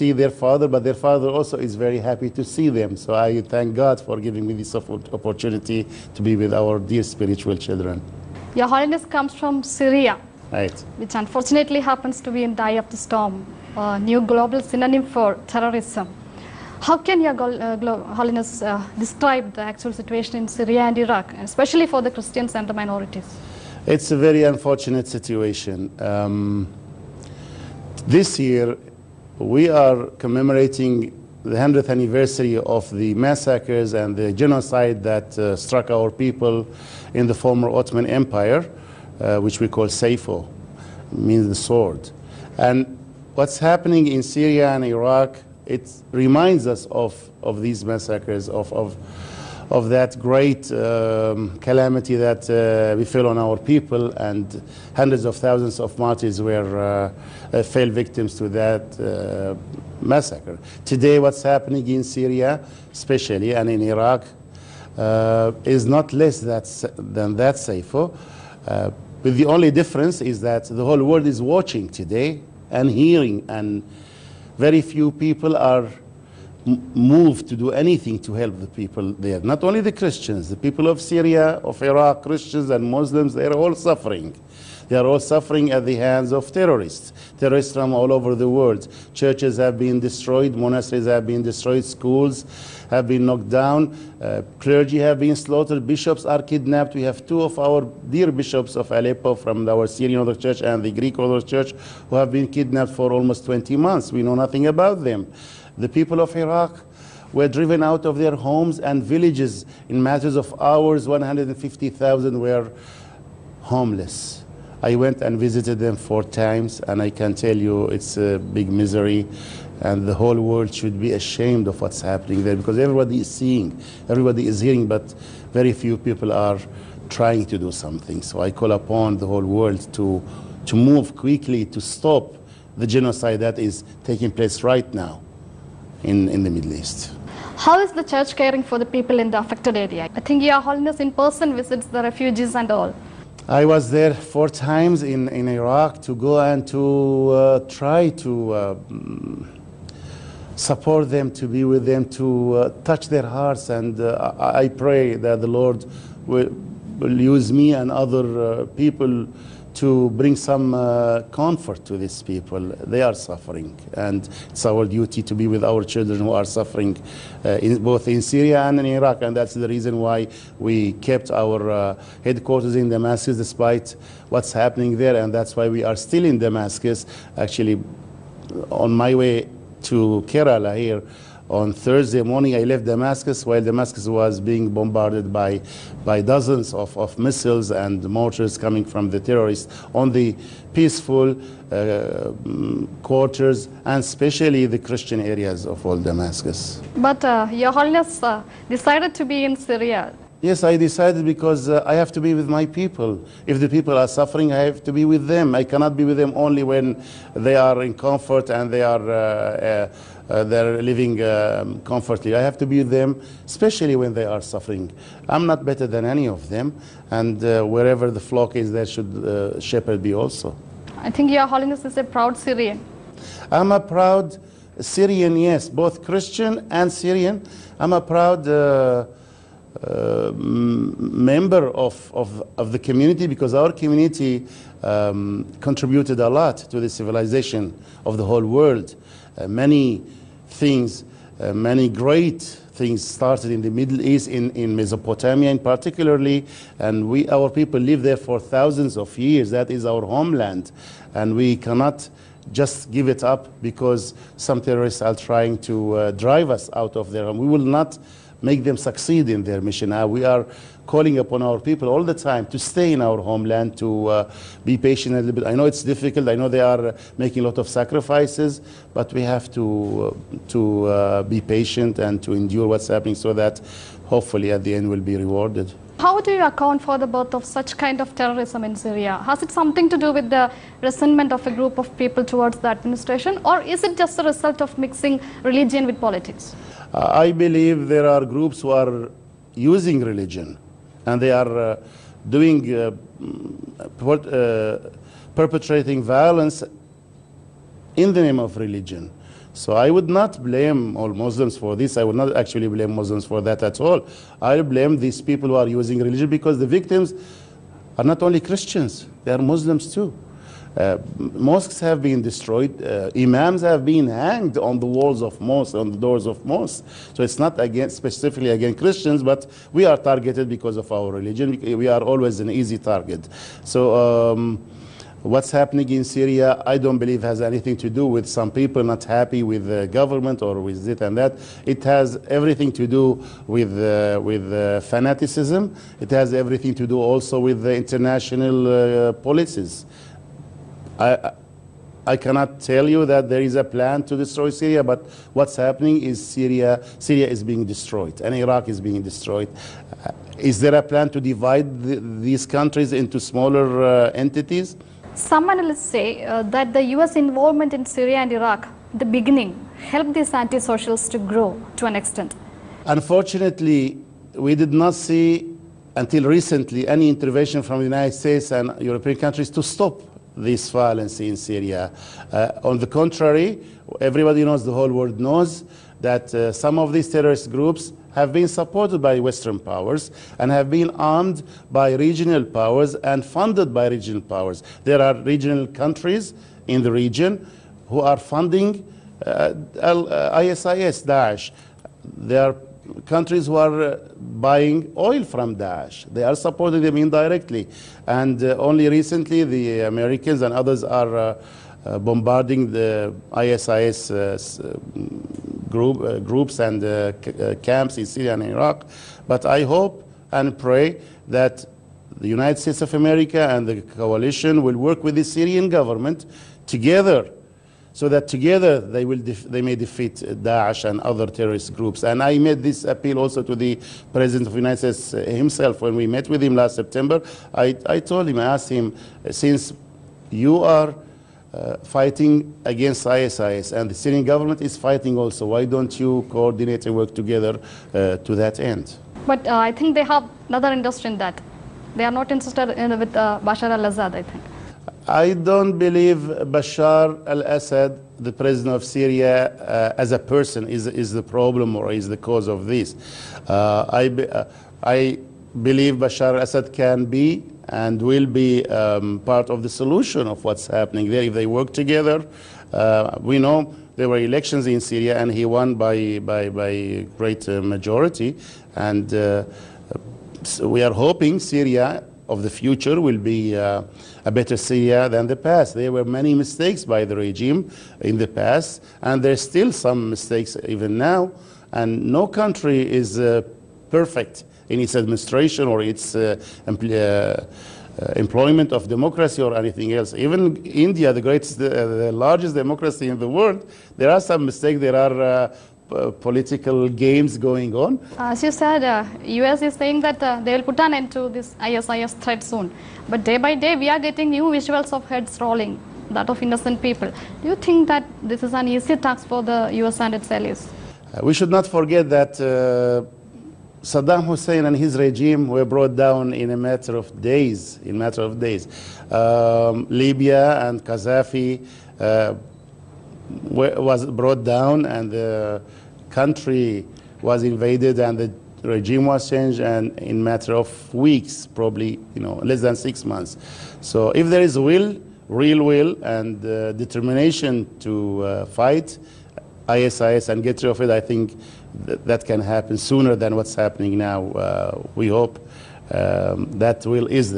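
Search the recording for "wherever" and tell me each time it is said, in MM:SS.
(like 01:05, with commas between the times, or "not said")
03:37.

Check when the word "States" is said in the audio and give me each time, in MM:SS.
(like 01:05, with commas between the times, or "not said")
06:08, 06:52, 07:04.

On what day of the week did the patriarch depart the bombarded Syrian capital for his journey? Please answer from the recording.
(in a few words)
Thursday.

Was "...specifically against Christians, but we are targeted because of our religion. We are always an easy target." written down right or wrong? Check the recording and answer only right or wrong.
right.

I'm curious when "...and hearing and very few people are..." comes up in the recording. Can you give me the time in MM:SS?
01:12.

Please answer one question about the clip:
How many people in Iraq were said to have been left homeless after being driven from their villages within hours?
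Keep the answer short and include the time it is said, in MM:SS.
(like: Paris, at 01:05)
150,000, at 01:51.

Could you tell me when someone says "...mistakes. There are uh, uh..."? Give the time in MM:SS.
08:14.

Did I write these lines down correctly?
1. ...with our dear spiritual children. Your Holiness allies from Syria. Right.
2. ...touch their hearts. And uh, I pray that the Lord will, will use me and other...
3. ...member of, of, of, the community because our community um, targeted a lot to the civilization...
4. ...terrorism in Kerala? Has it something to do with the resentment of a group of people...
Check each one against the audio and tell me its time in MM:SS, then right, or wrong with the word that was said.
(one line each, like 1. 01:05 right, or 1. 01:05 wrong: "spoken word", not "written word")
1. 00:06 wrong: "comes", not "allies"
2. 02:32 right
3. 03:50 wrong: "contributed", not "targeted"
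4. 04:38 wrong: "Syria", not "Kerala".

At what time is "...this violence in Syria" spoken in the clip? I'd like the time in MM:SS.
06:10.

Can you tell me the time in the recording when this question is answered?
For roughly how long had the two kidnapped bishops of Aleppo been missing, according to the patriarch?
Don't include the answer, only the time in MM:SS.
01:43.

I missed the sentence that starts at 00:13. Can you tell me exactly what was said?
Uh, new global synonym for terrorism.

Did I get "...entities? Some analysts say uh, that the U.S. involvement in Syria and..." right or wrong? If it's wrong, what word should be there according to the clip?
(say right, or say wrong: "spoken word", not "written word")
right.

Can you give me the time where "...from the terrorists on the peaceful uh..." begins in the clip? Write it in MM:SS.
03:08.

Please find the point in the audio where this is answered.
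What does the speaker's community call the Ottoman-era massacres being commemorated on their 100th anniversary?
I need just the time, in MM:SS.
00:39.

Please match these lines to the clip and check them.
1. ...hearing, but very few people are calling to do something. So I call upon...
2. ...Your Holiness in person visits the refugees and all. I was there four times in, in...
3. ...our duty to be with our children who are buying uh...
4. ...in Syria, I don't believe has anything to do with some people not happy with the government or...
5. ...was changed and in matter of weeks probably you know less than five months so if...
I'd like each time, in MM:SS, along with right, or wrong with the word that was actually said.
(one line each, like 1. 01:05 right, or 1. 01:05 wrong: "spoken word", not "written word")
1. 02:04 wrong: "trying", not "calling"
2. 02:20 right
3. 02:44 wrong: "suffering", not "buying"
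4. 05:25 right
5. 08:49 wrong: "six", not "five".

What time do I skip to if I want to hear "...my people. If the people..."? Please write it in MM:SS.
03:22.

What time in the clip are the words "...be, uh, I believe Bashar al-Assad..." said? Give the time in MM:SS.
07:34.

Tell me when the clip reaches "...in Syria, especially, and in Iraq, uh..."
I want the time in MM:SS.
01:01.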